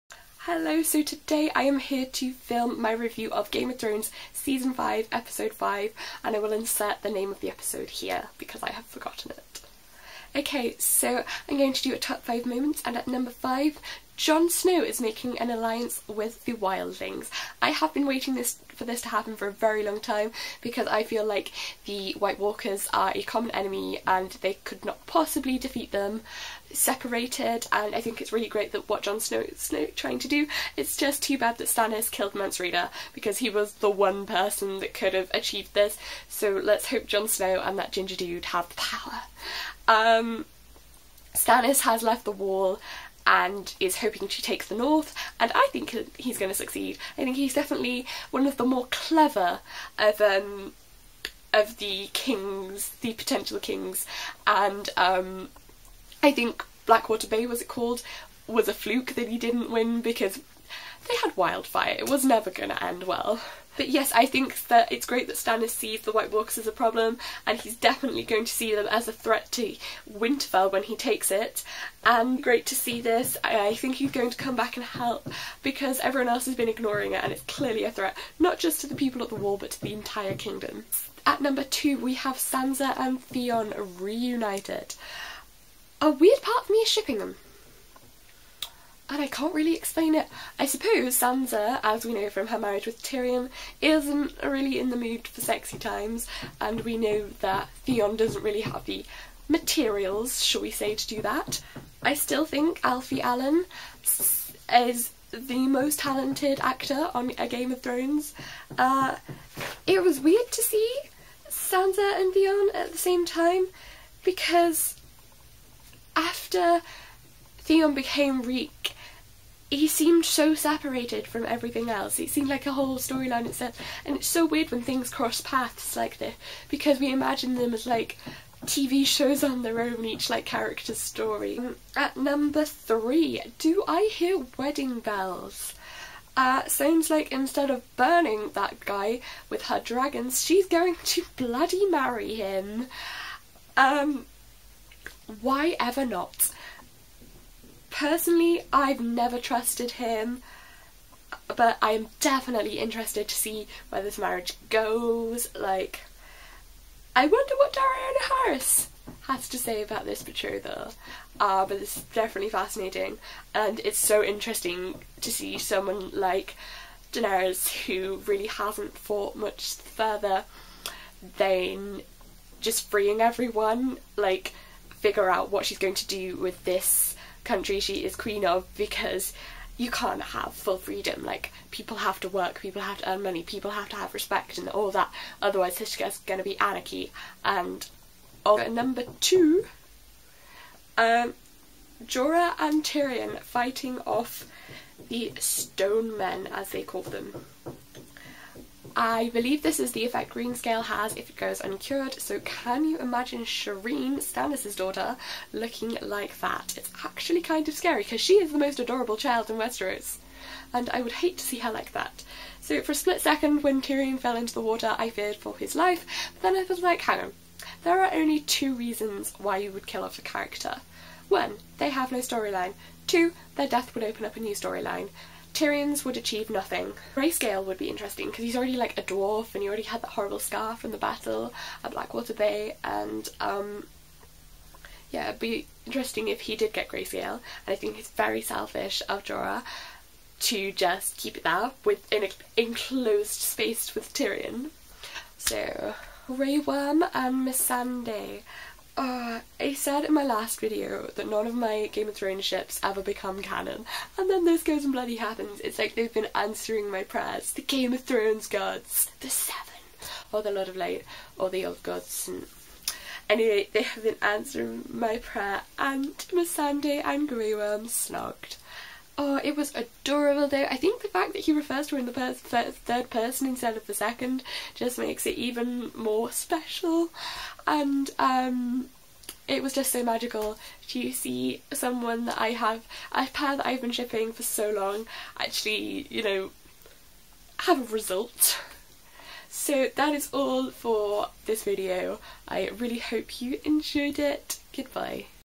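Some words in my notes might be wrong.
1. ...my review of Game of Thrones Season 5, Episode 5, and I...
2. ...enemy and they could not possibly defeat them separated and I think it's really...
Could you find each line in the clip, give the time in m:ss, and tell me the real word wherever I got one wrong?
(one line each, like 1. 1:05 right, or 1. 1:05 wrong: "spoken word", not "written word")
1. 0:02 right
2. 0:23 right.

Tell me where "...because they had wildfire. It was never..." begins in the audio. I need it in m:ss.
1:00.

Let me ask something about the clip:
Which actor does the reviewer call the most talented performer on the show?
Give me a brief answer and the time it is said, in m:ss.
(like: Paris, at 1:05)
Alfie Allen, at 1:42.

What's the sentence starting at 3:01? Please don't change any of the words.
Like people have to work, people have to earn money, people have to have respect and all that.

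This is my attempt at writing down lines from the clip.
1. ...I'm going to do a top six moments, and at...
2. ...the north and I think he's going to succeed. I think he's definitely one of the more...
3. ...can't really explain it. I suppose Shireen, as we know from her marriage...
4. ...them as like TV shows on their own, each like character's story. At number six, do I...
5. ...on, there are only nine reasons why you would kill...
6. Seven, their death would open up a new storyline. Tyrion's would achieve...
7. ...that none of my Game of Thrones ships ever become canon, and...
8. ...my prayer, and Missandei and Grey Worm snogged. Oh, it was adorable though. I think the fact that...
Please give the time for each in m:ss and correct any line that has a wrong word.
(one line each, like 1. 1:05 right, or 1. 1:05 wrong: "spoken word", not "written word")
1. 0:11 wrong: "five", not "six"
2. 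0:44 right
3. 1:29 wrong: "Sansa", not "Shireen"
4. 2:07 wrong: "three", not "six"
5. 3:37 wrong: "two", not "nine"
6. 3:43 wrong: "Two", not "Seven"
7. 4:11 right
8. 4:24 right.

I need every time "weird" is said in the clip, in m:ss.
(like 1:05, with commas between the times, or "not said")
1:26, 1:50, 2:04.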